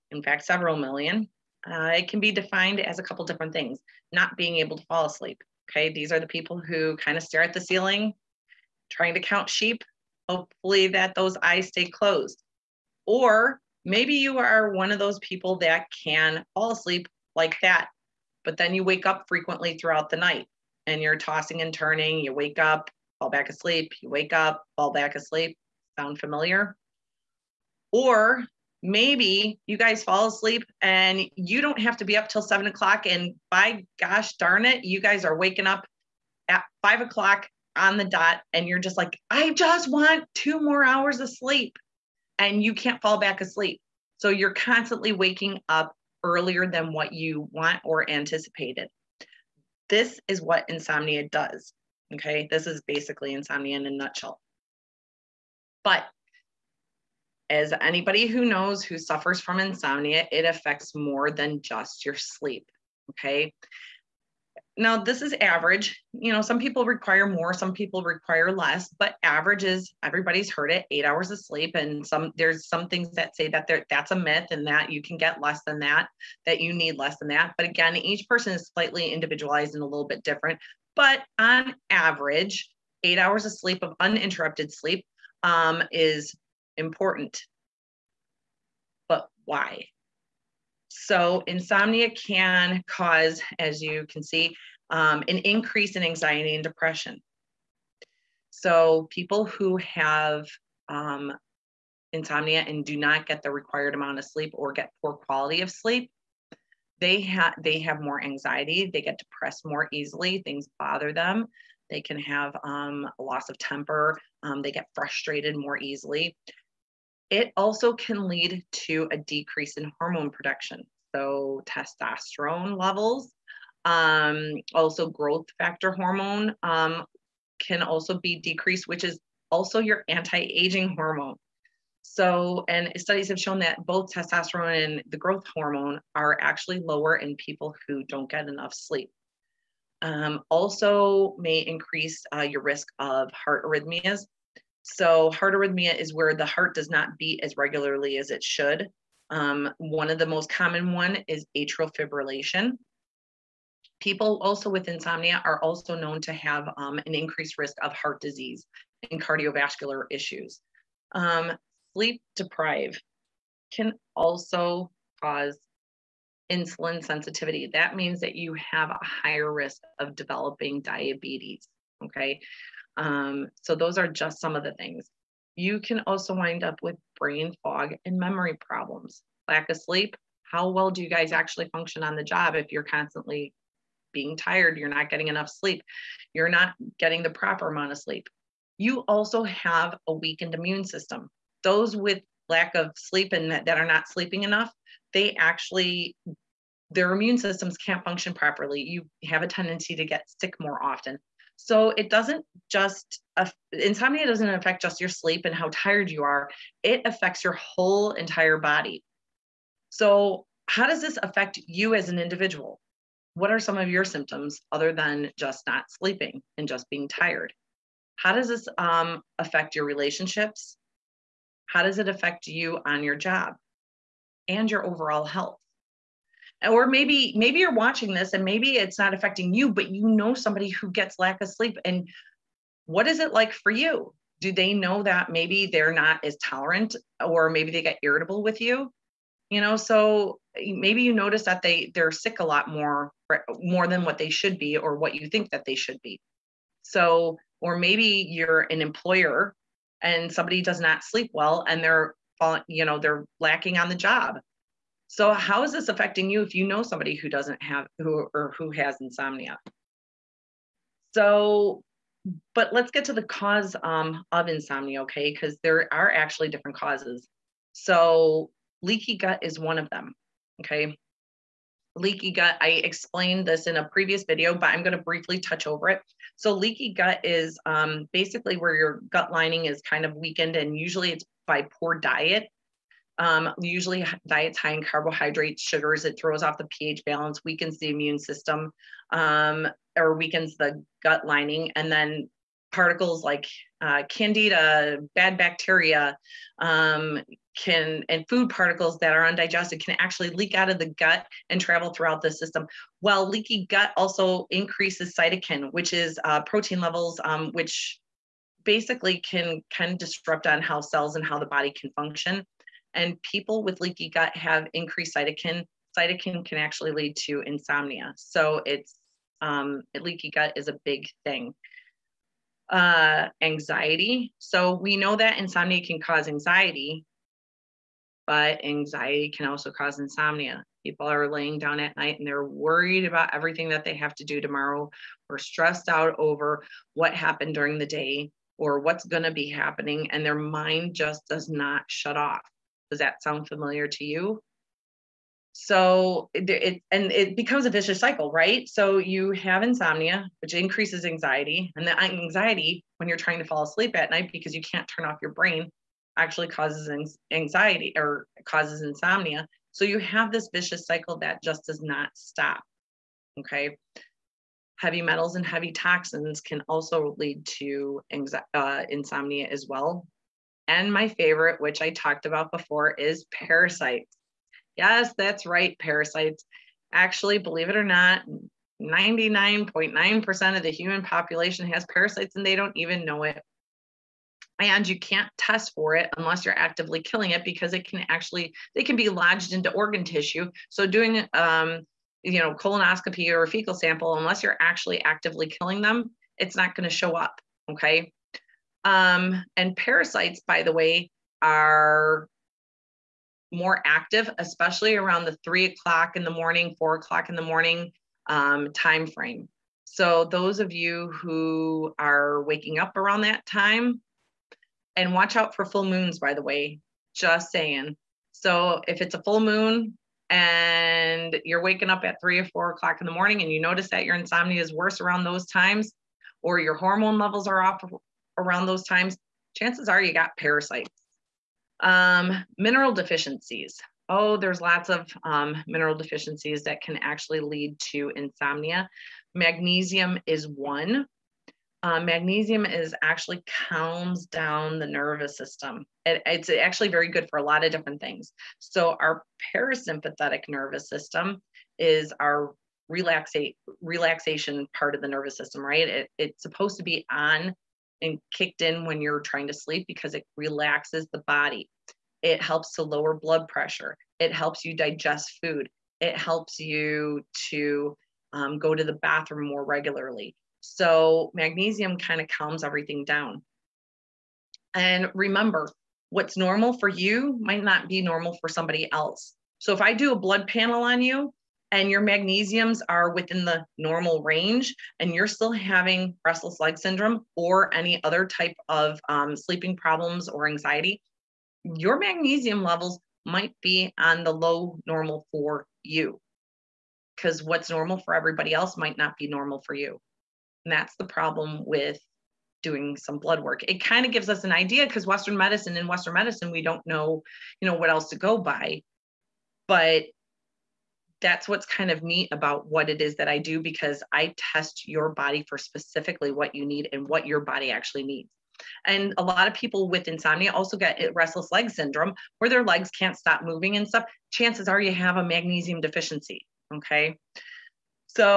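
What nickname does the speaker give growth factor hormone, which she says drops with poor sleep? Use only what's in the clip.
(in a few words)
anti-aging hormone.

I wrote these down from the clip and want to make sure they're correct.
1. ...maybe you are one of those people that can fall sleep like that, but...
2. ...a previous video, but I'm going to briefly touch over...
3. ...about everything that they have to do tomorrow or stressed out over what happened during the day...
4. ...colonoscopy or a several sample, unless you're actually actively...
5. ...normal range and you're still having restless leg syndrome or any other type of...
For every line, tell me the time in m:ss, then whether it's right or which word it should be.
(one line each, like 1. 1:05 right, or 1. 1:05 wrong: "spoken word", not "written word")
1. 0:13 wrong: "asleep", not "sleep"
2. 4:33 right
3. 5:33 right
4. 6:32 wrong: "fecal", not "several"
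5. 8:03 right.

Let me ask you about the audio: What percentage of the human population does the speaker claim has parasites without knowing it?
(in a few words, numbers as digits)
99.9%.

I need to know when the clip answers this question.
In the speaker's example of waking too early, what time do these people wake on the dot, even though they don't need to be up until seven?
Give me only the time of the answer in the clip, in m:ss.
0:36.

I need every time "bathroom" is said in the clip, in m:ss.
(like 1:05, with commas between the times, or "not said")
7:48.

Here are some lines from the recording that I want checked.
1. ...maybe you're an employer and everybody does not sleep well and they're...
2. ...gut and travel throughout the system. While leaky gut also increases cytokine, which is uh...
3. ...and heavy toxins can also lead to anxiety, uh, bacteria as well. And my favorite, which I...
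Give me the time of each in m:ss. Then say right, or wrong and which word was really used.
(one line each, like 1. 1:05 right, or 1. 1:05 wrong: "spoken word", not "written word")
1. 4:07 wrong: "somebody", not "everybody"
2. 5:00 right
3. 6:05 wrong: "insomnia", not "bacteria".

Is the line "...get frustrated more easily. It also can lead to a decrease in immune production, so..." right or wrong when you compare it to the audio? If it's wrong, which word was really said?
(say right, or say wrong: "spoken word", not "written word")
wrong: "hormone", not "immune".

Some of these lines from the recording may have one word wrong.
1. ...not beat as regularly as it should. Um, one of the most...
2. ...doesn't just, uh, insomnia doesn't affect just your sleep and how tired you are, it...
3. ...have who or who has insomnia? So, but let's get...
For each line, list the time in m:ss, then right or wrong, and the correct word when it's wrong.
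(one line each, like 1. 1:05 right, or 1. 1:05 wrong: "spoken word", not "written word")
1. 2:26 right
2. 3:22 right
3. 4:17 right.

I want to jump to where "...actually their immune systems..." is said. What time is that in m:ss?
3:15.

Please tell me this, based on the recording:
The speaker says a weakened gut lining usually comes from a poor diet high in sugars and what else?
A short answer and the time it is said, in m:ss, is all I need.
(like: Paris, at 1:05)
carbohydrates, at 4:44.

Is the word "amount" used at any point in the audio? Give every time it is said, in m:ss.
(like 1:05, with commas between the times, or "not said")
1:43, 3:07.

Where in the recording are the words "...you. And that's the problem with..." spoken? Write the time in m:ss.
8:19.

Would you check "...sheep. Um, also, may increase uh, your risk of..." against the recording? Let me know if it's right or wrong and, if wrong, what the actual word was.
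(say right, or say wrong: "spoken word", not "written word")
wrong: "sleep", not "sheep".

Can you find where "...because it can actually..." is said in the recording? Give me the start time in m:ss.
6:27.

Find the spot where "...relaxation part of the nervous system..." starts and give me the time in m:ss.
7:33.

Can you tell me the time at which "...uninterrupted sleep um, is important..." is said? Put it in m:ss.
1:24.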